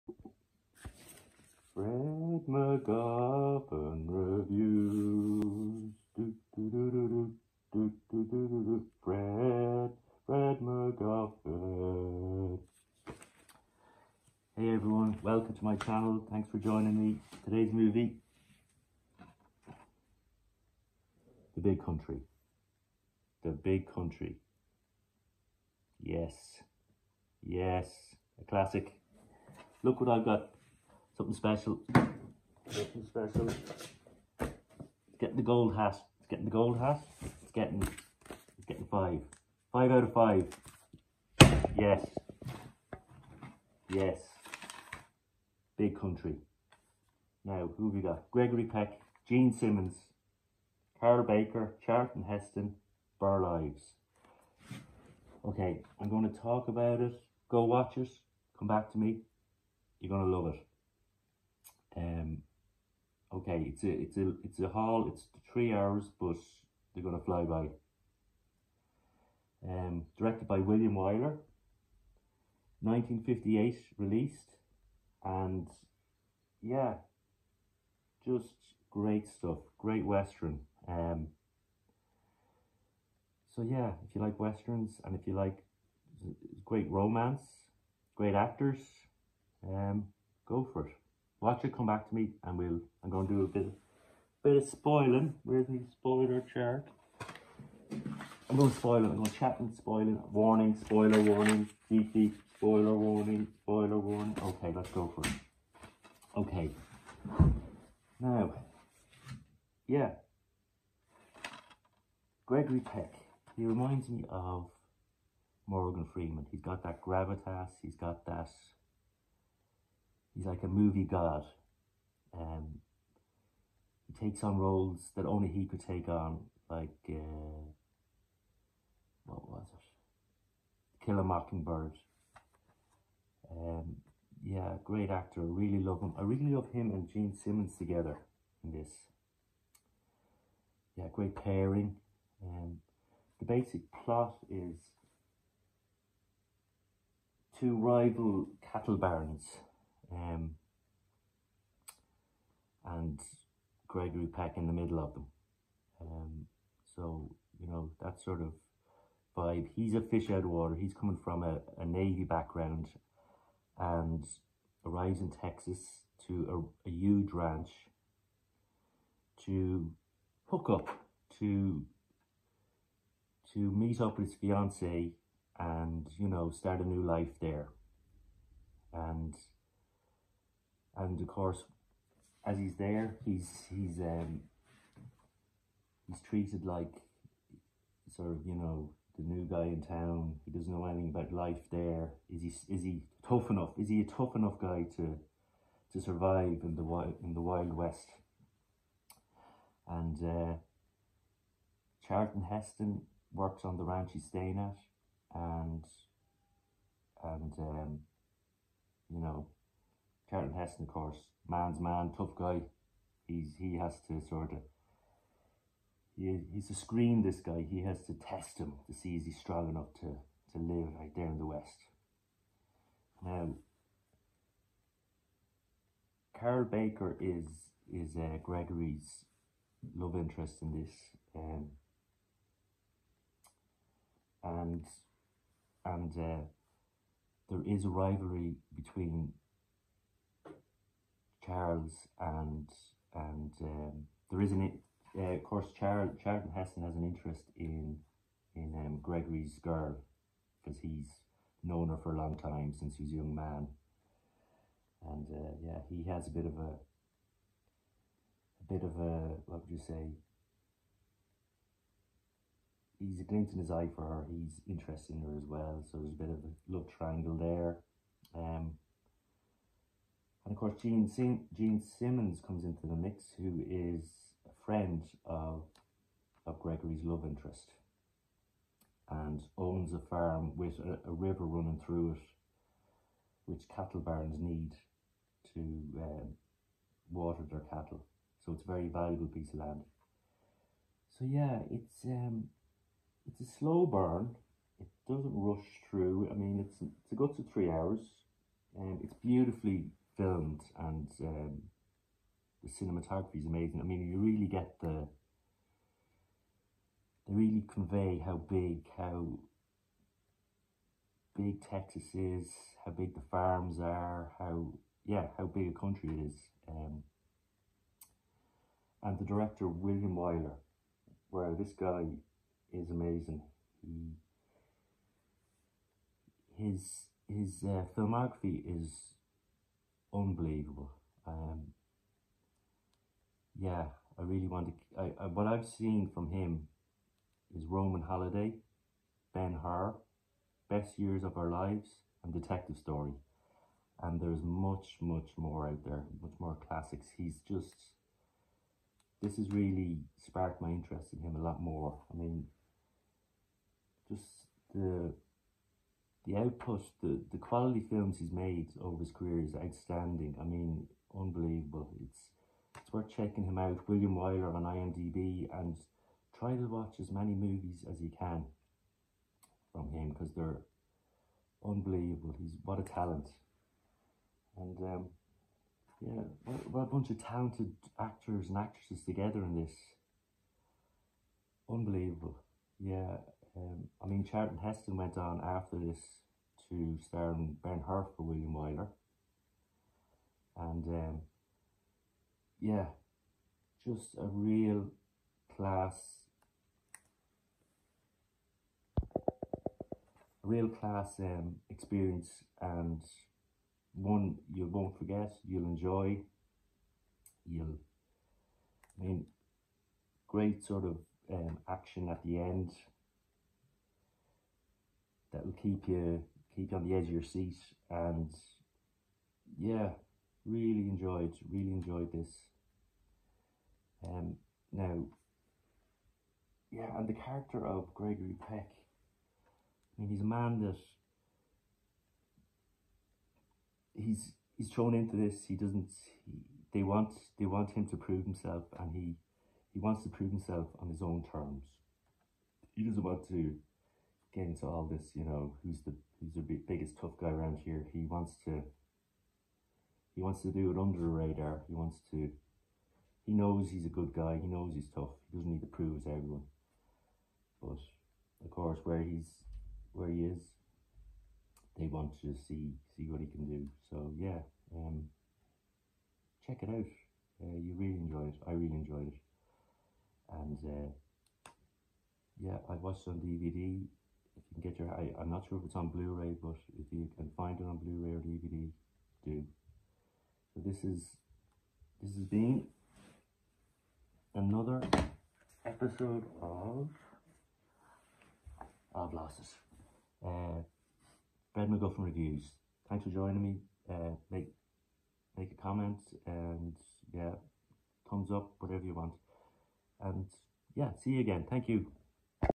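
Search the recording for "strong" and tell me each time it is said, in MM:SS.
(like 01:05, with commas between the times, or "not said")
03:39.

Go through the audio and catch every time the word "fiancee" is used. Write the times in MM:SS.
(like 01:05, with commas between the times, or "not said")
02:54.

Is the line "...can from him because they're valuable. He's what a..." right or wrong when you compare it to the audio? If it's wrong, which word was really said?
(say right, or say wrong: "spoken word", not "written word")
wrong: "unbelievable", not "valuable".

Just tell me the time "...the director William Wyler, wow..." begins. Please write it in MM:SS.
05:19.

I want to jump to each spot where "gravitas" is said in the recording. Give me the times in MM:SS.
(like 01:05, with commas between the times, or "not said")
01:57.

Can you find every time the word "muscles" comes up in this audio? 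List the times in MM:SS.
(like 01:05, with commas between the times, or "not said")
not said.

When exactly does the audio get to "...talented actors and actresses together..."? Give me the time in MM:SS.
06:17.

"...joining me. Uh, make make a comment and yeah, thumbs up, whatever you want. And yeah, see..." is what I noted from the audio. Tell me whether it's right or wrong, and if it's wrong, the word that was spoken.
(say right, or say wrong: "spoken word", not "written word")
right.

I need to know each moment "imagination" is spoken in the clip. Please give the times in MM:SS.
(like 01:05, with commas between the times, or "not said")
not said.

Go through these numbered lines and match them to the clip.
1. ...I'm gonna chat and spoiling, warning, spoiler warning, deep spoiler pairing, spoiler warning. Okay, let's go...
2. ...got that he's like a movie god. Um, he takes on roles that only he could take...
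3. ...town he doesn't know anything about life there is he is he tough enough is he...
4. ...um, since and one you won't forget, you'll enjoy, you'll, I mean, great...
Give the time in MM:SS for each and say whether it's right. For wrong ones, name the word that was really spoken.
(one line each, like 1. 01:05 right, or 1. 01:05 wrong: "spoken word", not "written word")
1. 01:39 wrong: "warning", not "pairing"
2. 01:57 right
3. 03:09 right
4. 06:41 wrong: "experience", not "since".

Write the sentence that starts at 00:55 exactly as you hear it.
Okay, I'm going to talk about it.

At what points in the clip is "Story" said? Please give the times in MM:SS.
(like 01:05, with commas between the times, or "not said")
05:42.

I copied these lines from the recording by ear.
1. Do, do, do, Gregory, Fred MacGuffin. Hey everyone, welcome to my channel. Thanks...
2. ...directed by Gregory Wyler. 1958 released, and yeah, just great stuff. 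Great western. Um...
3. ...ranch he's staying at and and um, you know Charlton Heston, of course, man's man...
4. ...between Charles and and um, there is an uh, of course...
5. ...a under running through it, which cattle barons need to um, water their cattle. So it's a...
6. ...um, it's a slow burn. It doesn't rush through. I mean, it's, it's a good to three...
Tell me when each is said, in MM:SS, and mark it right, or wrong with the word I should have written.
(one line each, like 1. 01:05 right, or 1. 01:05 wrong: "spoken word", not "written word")
1. 00:06 wrong: "Fred", not "Gregory"
2. 01:10 wrong: "William", not "Gregory"
3. 03:23 right
4. 03:58 right
5. 04:41 wrong: "river", not "under"
6. 04:52 right.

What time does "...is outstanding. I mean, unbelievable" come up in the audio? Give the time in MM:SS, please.
05:59.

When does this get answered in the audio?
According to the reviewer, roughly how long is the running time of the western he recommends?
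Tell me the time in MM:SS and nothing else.
01:05.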